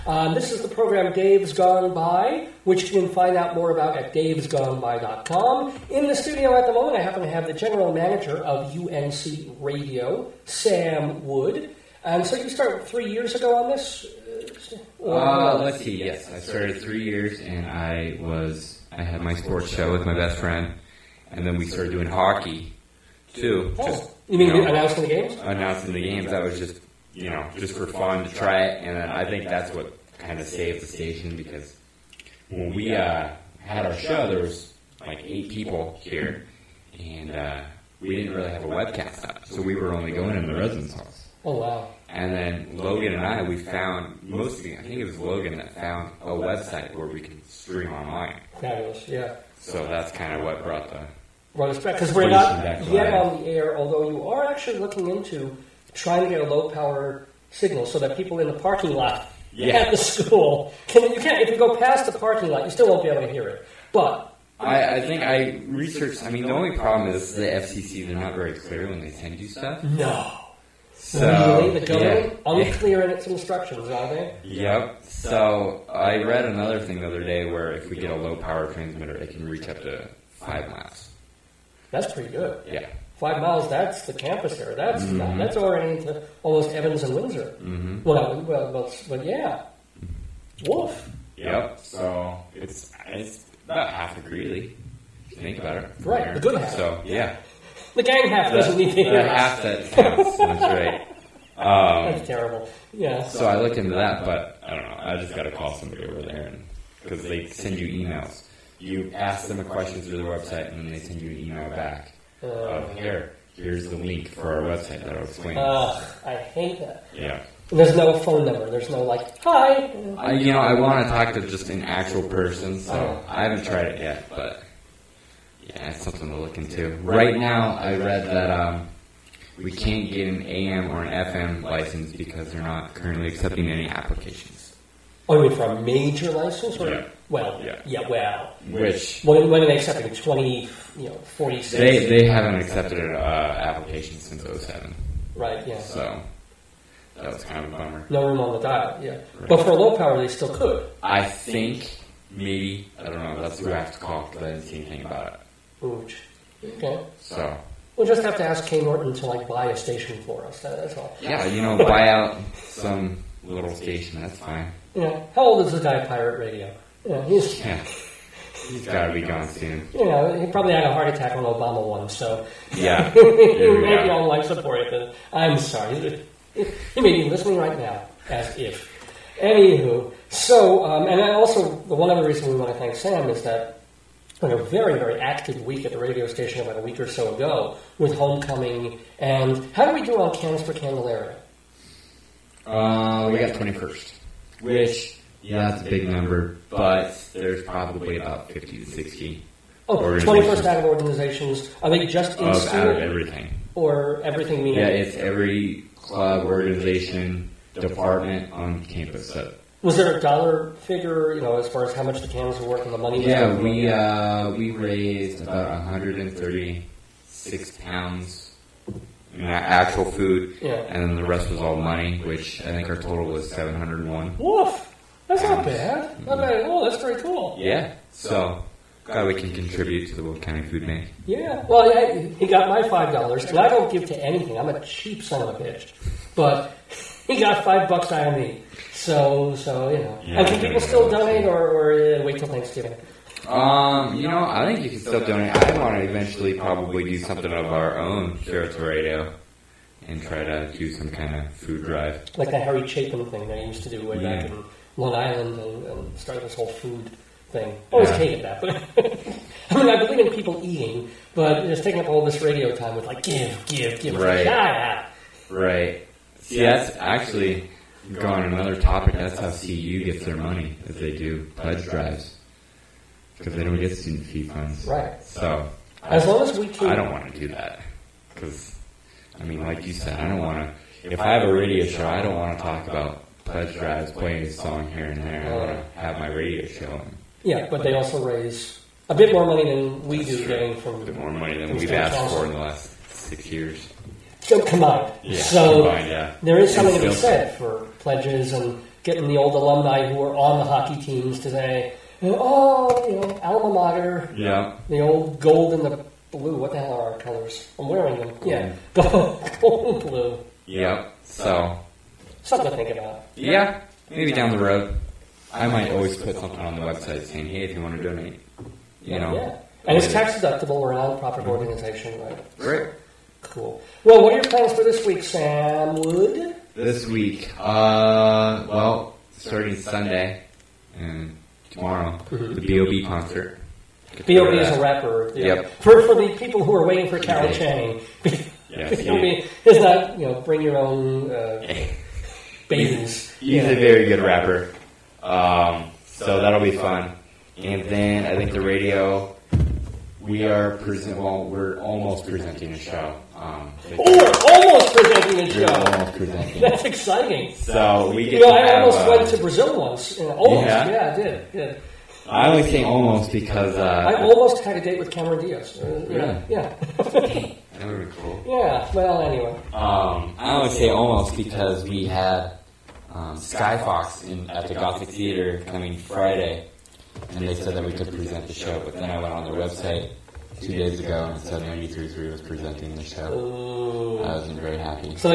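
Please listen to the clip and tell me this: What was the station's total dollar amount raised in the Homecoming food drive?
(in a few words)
701.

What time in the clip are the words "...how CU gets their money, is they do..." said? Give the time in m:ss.
4:29.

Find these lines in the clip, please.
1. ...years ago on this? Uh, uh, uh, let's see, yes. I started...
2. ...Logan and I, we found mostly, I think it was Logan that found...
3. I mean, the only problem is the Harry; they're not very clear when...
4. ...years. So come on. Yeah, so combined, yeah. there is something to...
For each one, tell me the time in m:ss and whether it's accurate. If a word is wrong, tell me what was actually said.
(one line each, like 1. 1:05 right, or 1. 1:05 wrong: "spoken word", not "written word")
1. 0:13 right
2. 0:42 right
3. 1:06 wrong: "FCC", not "Harry"
4. 4:53 right.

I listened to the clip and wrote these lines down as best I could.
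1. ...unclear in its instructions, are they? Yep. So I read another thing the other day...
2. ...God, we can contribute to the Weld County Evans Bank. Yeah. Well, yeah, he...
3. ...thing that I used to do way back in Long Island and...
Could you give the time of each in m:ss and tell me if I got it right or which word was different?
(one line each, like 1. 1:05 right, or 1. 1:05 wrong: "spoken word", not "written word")
1. 1:12 right
2. 3:49 wrong: "Food", not "Evans"
3. 4:13 right.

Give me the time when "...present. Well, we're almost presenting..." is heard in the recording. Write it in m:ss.
5:50.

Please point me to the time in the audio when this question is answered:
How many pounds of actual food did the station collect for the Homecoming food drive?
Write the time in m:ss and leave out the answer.
3:35.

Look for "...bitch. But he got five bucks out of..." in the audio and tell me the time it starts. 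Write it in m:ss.
3:55.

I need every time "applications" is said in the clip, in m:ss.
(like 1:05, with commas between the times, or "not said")
2:13, 2:23.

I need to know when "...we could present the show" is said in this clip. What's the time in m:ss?
6:17.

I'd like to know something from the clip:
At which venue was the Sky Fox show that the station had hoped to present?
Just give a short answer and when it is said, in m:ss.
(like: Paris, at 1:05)
Gothic Theater, at 6:14.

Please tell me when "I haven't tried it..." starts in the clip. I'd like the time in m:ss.
2:03.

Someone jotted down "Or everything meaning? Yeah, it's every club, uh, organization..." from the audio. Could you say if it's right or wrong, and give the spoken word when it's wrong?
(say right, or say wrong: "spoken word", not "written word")
right.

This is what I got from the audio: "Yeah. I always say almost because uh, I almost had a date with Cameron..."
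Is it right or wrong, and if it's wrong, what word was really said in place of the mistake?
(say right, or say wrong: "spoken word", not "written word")
right.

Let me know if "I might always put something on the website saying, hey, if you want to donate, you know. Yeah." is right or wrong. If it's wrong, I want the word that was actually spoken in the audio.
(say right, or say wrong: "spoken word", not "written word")
right.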